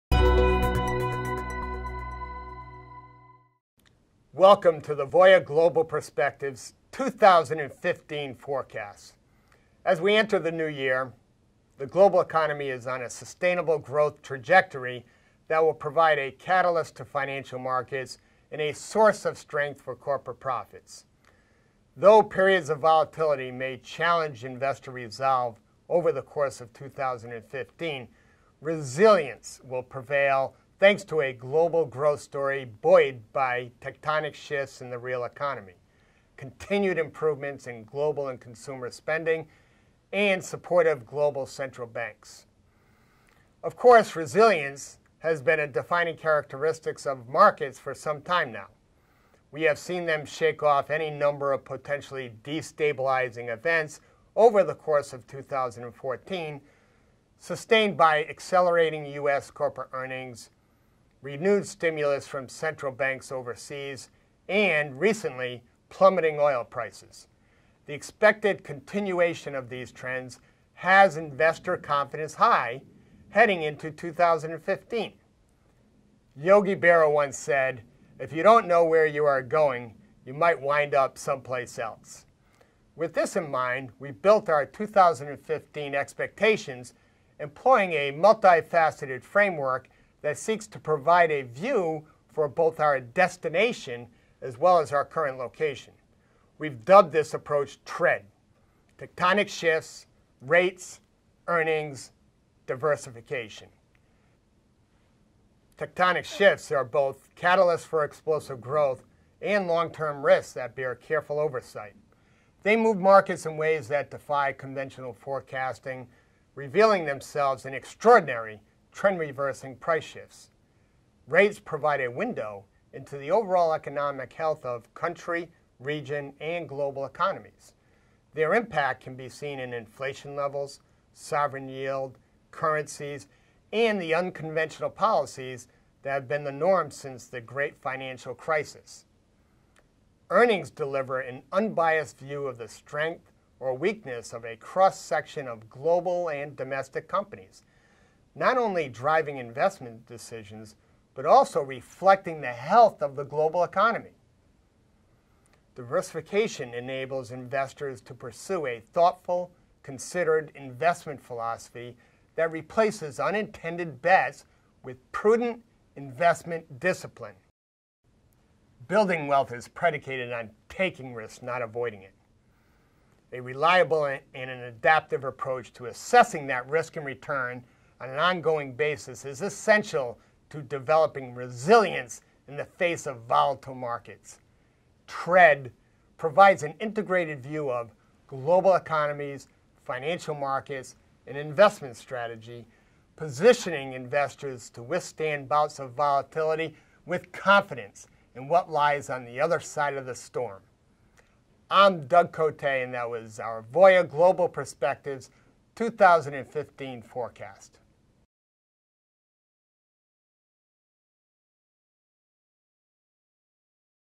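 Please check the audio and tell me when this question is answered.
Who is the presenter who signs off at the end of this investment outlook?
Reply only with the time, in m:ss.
3:22.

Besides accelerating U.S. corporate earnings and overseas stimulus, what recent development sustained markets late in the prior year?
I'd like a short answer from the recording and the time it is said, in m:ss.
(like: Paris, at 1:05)
plummeting oil prices, at 1:05.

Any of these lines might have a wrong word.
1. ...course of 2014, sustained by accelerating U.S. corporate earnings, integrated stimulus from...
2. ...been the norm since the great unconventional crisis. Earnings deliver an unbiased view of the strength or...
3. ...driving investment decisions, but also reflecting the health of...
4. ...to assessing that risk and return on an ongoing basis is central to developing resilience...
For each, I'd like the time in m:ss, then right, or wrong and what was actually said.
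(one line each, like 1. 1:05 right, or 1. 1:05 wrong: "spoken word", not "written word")
1. 0:54 wrong: "renewed", not "integrated"
2. 2:16 wrong: "financial", not "unconventional"
3. 2:28 right
4. 2:55 wrong: "essential", not "central".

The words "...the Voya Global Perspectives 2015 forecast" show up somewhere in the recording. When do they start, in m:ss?
0:04.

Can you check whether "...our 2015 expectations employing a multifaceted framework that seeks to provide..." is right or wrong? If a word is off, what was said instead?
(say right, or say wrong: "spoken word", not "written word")
right.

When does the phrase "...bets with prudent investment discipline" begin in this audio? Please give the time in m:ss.
2:44.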